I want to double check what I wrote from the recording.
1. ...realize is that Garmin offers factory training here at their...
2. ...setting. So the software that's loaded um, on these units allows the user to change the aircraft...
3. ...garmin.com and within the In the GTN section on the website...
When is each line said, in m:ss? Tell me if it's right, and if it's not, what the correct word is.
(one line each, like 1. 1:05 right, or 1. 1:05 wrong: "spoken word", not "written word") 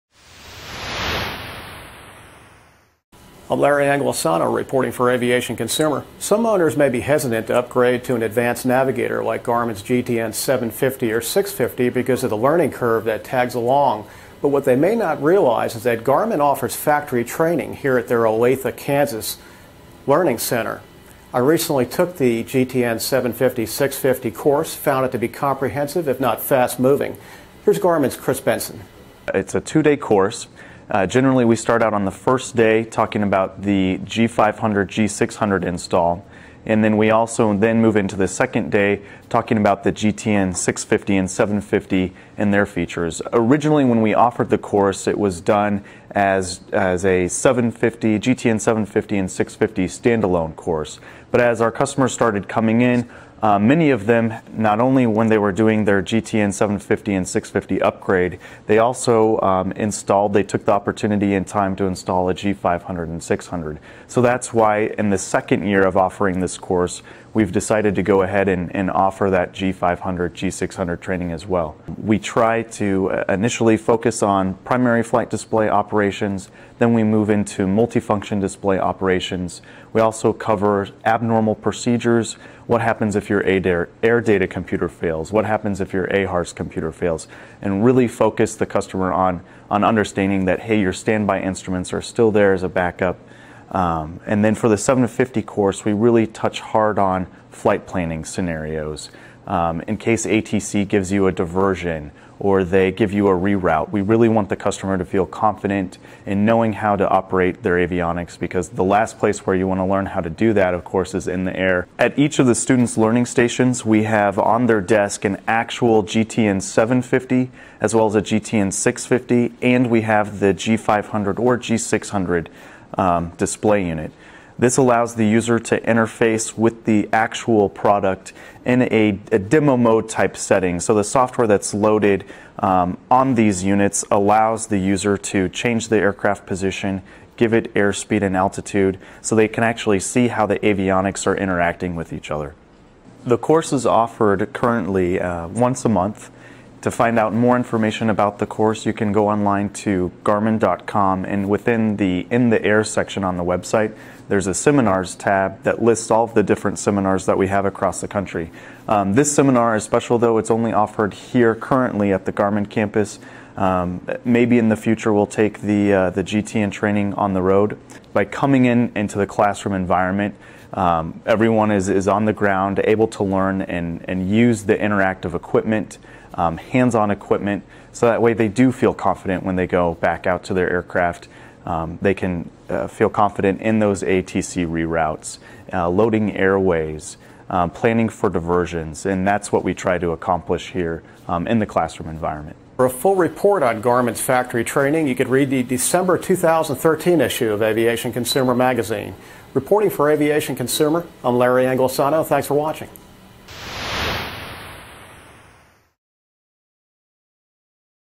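1. 0:15 right
2. 2:10 right
3. 2:30 wrong: "Air", not "GTN".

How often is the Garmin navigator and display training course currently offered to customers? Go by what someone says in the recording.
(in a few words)
once a month.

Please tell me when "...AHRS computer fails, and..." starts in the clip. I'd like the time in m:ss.
1:26.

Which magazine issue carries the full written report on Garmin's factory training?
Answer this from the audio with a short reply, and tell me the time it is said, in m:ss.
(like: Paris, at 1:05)
December 2013, at 3:15.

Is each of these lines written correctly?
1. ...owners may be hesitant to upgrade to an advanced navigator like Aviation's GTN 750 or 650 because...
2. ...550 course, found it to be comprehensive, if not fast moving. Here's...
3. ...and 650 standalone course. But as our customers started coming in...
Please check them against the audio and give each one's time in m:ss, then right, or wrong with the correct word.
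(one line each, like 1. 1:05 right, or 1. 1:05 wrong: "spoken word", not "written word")
1. 0:06 wrong: "Garmin", not "Aviation"
2. 0:23 wrong: "650", not "550"
3. 0:49 right.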